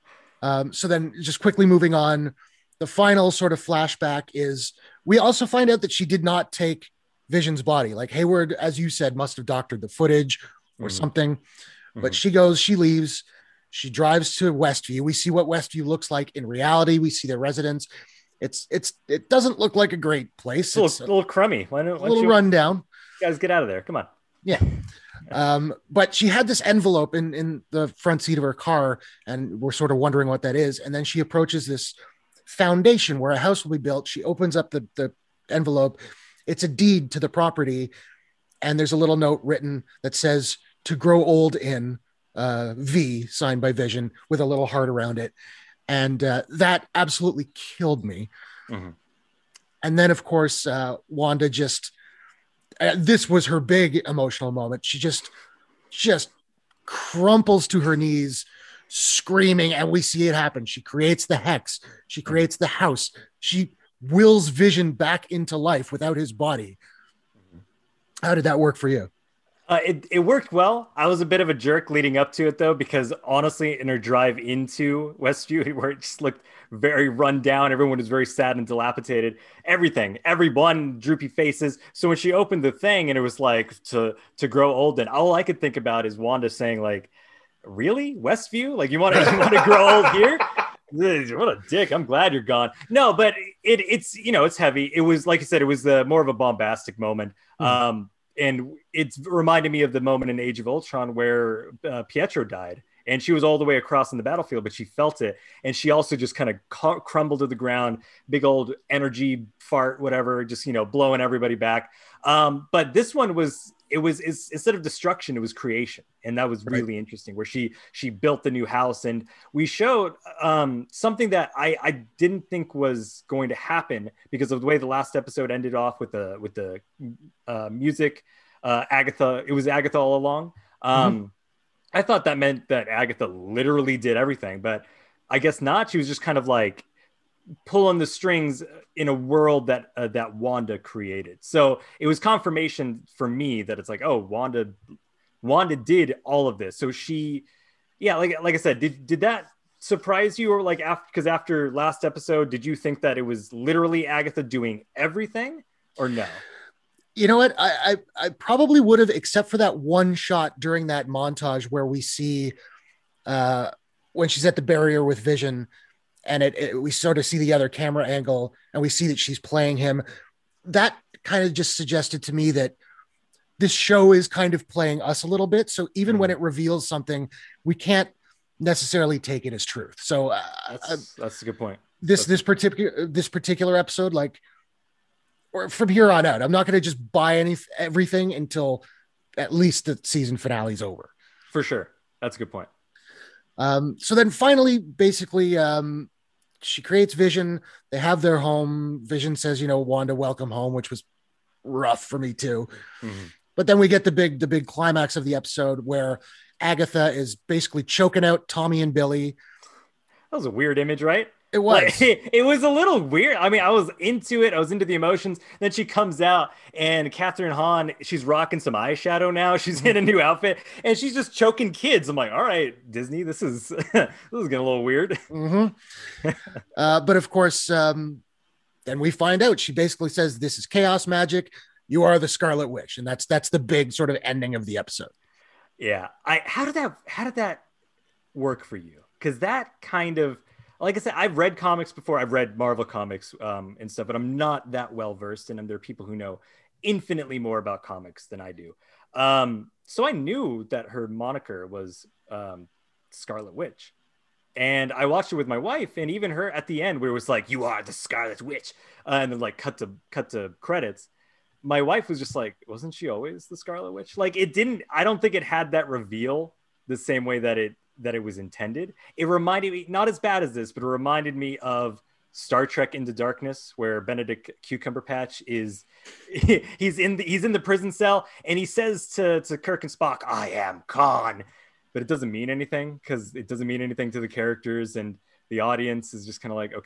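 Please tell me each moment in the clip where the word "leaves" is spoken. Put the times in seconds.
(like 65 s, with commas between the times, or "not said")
12 s.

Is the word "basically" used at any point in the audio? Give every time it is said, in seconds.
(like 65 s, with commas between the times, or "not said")
194 s, 207 s, 229 s.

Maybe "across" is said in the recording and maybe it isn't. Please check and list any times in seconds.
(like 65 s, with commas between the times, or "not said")
103 s.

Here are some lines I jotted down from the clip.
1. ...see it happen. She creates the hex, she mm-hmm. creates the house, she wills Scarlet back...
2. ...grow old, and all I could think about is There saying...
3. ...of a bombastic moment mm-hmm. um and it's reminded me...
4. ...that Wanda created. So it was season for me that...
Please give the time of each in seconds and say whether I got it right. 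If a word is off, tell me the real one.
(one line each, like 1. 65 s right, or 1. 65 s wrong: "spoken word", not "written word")
1. 60 s wrong: "Vision", not "Scarlet"
2. 84 s wrong: "Wanda", not "There"
3. 96 s right
4. 140 s wrong: "confirmation", not "season".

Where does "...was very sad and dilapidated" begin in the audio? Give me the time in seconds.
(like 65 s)
77 s.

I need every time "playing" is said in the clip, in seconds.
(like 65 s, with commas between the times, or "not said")
169 s, 174 s.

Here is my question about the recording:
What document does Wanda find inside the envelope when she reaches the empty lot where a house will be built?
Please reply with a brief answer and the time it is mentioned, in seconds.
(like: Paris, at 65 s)
A deed, at 36 s.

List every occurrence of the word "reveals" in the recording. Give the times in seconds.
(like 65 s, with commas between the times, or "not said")
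176 s, 265 s.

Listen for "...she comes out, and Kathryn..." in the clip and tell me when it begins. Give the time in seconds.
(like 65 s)
215 s.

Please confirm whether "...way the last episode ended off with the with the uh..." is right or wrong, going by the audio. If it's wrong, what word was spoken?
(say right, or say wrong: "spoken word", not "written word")
right.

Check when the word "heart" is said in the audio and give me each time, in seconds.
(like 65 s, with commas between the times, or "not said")
44 s.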